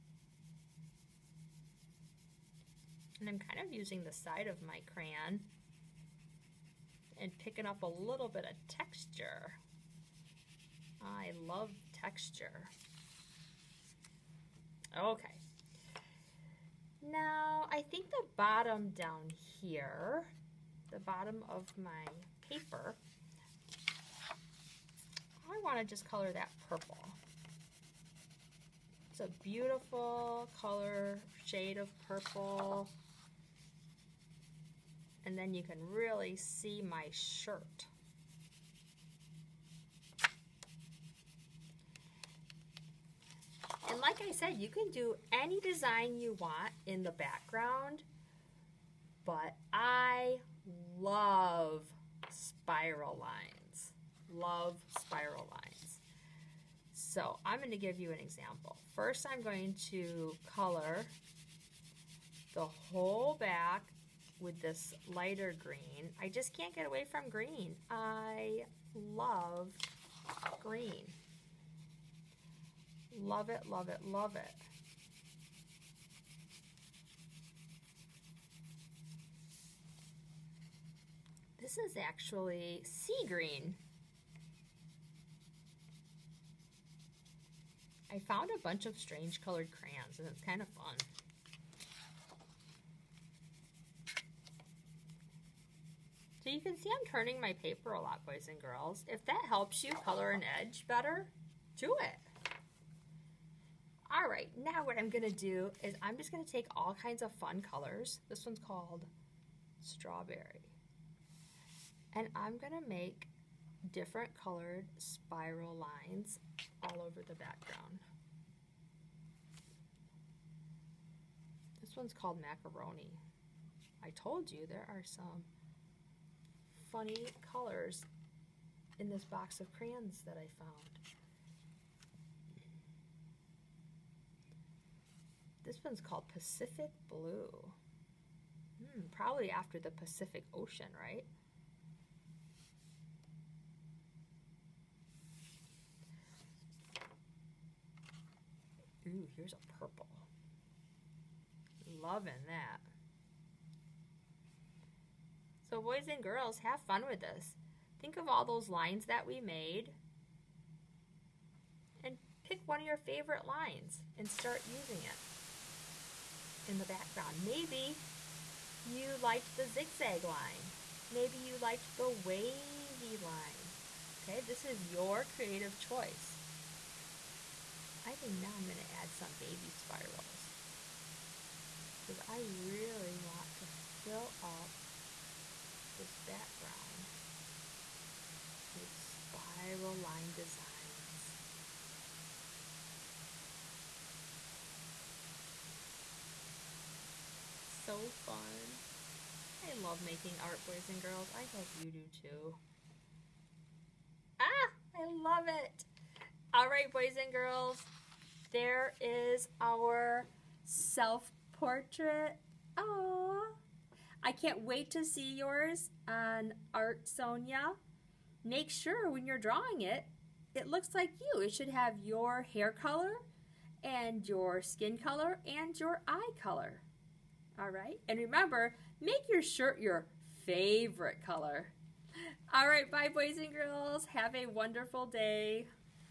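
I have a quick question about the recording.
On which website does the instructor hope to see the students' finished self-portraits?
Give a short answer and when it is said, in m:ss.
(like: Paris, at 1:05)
Artsonia, at 3:36.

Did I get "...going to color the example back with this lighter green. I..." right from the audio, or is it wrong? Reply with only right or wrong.
wrong.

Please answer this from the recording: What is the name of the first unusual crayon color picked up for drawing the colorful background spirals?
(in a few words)
Strawberry.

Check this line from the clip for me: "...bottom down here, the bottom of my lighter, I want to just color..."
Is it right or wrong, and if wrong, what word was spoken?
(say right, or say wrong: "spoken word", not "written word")
wrong: "paper", not "lighter".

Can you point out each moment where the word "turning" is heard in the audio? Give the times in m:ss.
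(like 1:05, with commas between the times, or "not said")
1:37.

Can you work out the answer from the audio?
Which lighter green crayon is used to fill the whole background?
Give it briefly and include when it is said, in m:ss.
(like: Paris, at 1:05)
Sea green, at 1:22.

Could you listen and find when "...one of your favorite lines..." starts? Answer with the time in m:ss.
2:42.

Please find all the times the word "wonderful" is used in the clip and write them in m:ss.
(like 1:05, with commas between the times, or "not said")
3:54.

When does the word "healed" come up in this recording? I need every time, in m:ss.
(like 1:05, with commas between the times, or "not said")
not said.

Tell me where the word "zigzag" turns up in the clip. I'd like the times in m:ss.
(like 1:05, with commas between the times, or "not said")
2:49.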